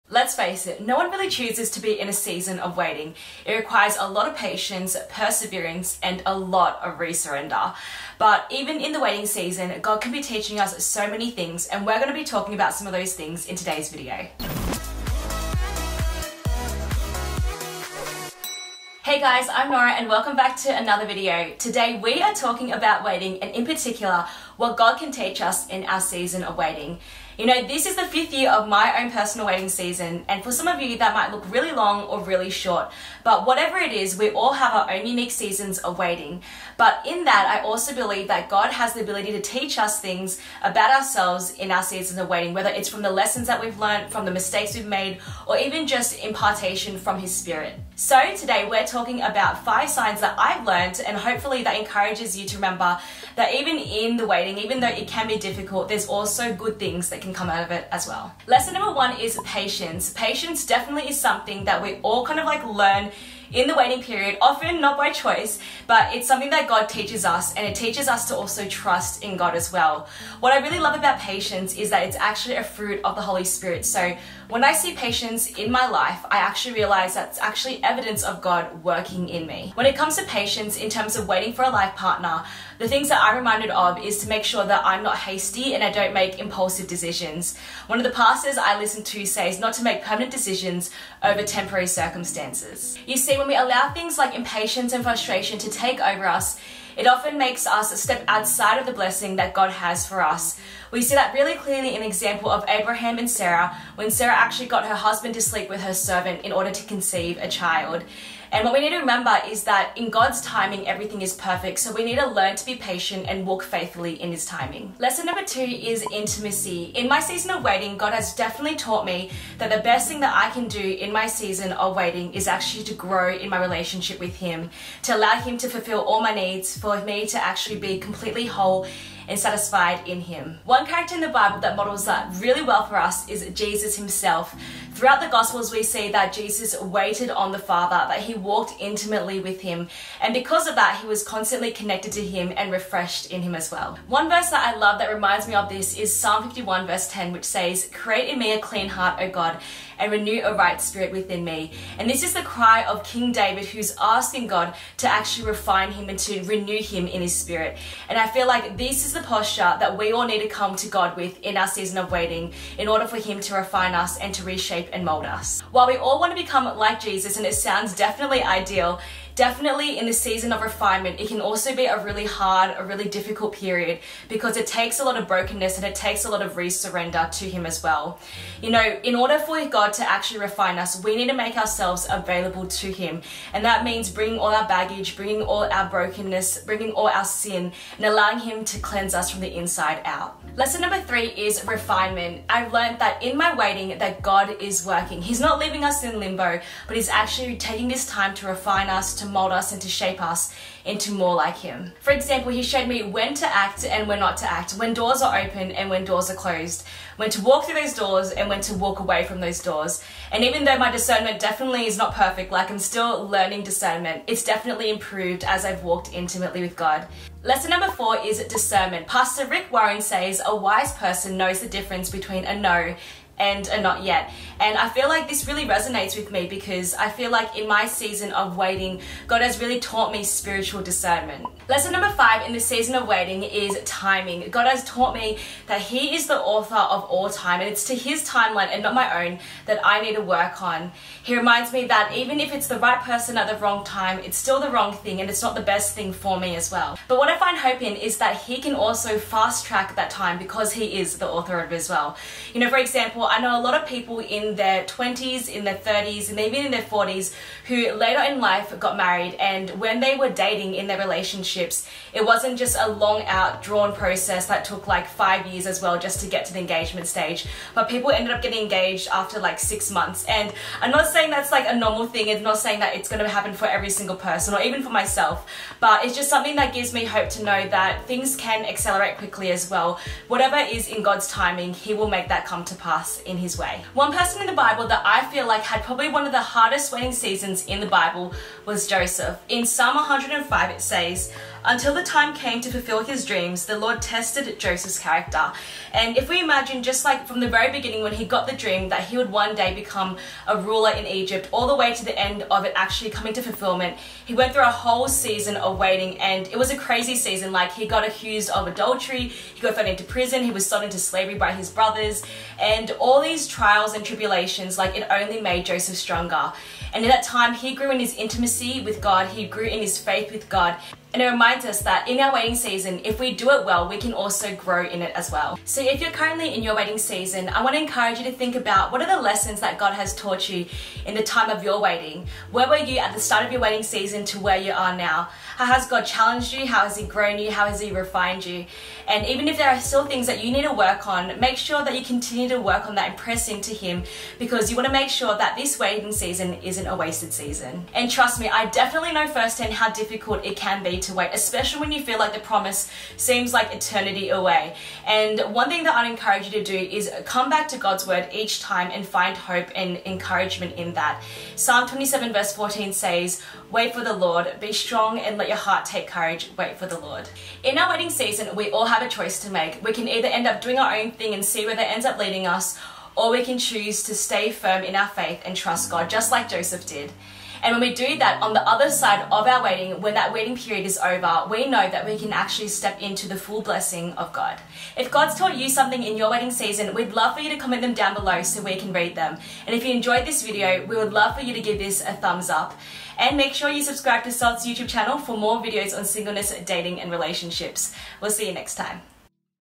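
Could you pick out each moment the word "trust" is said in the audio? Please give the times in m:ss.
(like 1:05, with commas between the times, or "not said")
1:08, 5:48, 6:15.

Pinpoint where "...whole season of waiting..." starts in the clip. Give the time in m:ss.
5:04.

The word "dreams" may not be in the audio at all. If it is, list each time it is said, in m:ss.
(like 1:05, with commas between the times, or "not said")
4:53, 4:58.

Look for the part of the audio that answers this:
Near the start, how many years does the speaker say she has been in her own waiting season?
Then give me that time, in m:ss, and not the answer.
0:28.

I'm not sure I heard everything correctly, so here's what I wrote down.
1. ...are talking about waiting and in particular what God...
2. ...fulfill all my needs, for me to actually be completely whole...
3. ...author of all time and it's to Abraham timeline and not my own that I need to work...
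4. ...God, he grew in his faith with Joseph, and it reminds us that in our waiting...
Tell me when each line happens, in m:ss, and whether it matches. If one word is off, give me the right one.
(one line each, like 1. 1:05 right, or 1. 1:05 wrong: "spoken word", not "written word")
1. 0:22 right
2. 2:05 right
3. 3:56 wrong: "His", not "Abraham"
4. 5:18 wrong: "God", not "Joseph".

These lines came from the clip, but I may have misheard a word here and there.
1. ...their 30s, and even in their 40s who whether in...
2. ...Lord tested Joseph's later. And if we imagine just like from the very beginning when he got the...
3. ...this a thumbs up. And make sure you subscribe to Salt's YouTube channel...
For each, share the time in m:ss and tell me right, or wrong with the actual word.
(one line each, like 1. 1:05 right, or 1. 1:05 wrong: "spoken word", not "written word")
1. 4:15 wrong: "later", not "whether"
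2. 4:53 wrong: "character", not "later"
3. 6:31 right.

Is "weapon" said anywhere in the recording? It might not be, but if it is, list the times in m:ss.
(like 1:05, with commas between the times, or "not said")
not said.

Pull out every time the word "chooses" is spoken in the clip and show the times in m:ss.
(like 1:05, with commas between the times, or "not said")
0:01, 6:13.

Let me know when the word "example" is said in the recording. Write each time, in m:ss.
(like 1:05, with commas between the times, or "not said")
1:42, 3:22, 4:12.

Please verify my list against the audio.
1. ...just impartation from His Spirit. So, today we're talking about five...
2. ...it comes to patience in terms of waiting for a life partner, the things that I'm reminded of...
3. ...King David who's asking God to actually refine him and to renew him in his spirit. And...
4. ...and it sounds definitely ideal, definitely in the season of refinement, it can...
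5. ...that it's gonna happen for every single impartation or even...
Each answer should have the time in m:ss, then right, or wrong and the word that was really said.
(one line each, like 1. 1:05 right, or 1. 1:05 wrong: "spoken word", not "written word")
1. 0:45 right
2. 1:19 right
3. 2:33 right
4. 2:47 right
5. 4:32 wrong: "person", not "impartation".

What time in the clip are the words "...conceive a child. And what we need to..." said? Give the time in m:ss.
1:46.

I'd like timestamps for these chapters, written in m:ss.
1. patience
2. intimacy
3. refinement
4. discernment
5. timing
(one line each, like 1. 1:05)
1. 1:00
2. 1:55
3. 3:10
4. 3:38
5. 3:52.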